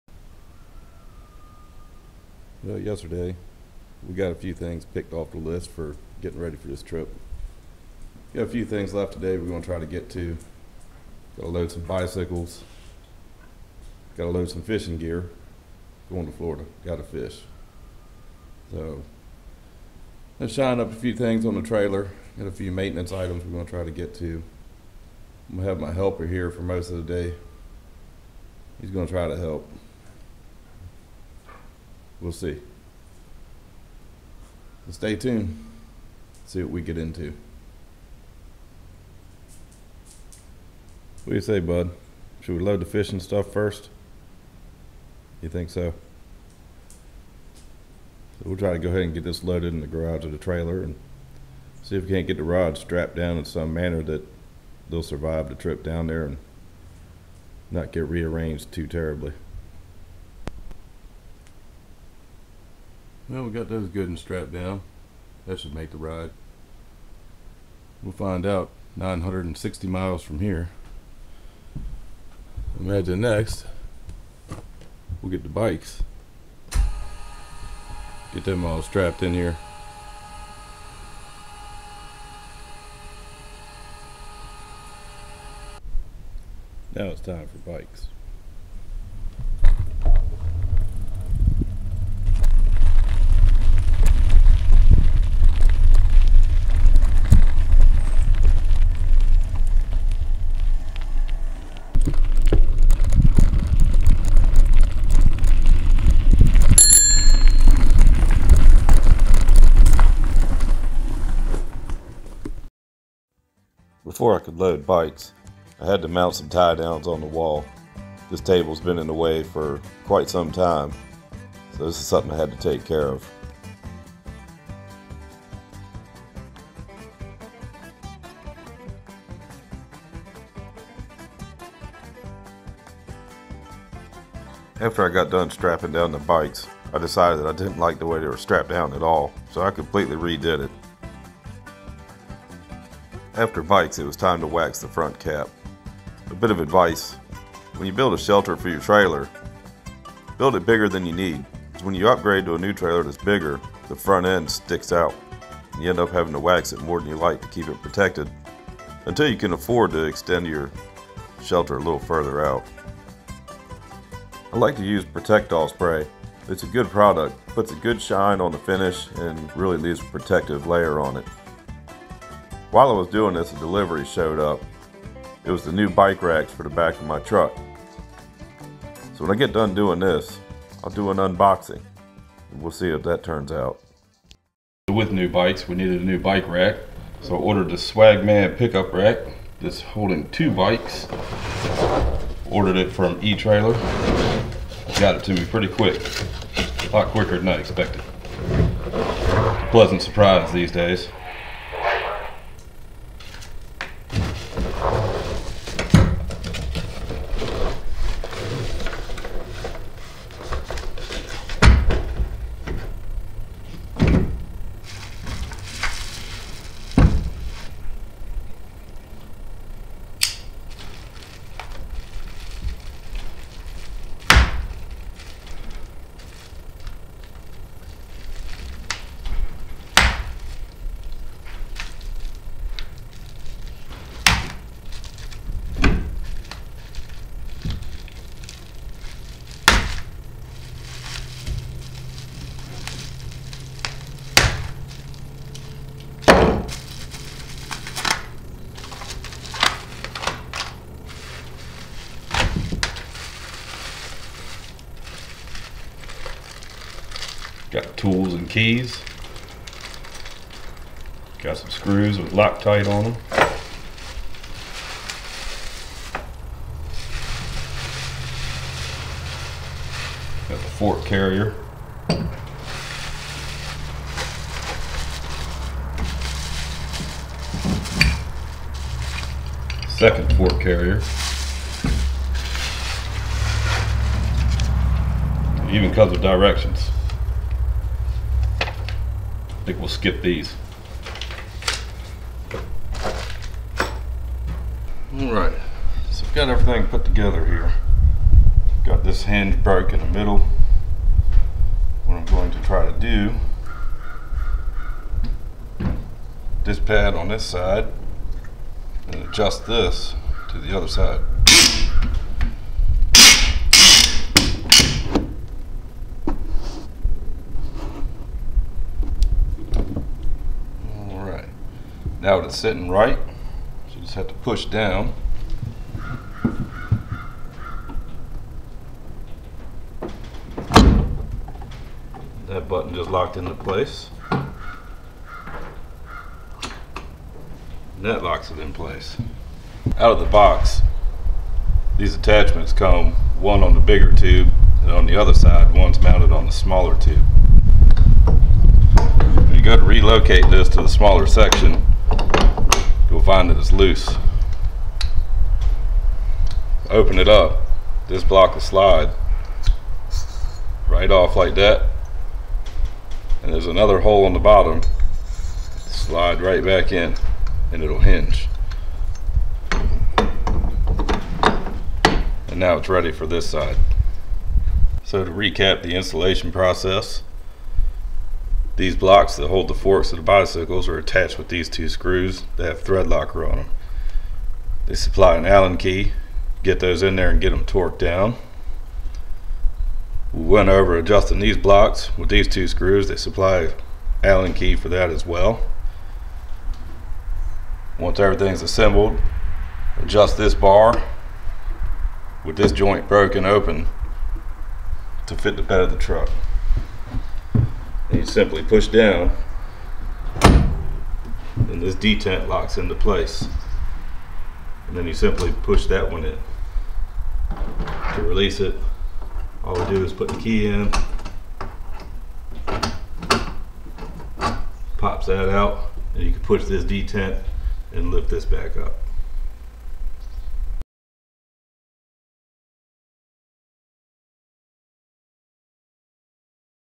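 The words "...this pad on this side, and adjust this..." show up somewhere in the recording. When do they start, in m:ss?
5:06.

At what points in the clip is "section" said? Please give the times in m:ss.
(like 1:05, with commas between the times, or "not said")
5:51.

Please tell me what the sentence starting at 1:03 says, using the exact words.
Well, we got those good and strapped down.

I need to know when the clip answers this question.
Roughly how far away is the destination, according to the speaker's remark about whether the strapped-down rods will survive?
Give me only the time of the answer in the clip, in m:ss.
1:08.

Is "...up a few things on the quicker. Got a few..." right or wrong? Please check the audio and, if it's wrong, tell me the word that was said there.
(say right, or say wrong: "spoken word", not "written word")
wrong: "trailer", not "quicker".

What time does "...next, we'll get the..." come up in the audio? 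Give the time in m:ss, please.
1:13.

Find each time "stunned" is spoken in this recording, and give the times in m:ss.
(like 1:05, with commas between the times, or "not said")
not said.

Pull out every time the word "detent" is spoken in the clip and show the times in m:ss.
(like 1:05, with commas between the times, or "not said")
6:51, 7:06.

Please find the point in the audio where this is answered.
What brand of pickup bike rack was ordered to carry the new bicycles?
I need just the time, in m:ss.
3:07.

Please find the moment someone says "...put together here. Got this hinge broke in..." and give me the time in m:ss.
4:56.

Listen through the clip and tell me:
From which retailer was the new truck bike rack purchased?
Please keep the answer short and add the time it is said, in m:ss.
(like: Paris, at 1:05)
e-trailer, at 3:13.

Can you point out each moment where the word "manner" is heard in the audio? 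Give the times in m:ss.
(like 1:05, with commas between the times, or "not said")
0:53.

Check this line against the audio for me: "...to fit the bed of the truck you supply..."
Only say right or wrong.
wrong.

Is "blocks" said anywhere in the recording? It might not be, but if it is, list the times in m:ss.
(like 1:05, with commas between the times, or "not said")
5:58, 6:18, 6:31.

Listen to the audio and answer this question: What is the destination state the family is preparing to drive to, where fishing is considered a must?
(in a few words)
Florida.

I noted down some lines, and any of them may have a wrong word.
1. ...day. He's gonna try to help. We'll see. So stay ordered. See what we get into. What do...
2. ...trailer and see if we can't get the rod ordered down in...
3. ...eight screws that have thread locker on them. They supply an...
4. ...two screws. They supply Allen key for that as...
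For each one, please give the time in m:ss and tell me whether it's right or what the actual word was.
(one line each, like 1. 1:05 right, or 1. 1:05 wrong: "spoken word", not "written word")
1. 0:27 wrong: "tuned", not "ordered"
2. 0:50 wrong: "strapped", not "ordered"
3. 6:21 wrong: "two", not "eight"
4. 6:32 right.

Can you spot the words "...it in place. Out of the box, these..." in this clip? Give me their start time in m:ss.
5:38.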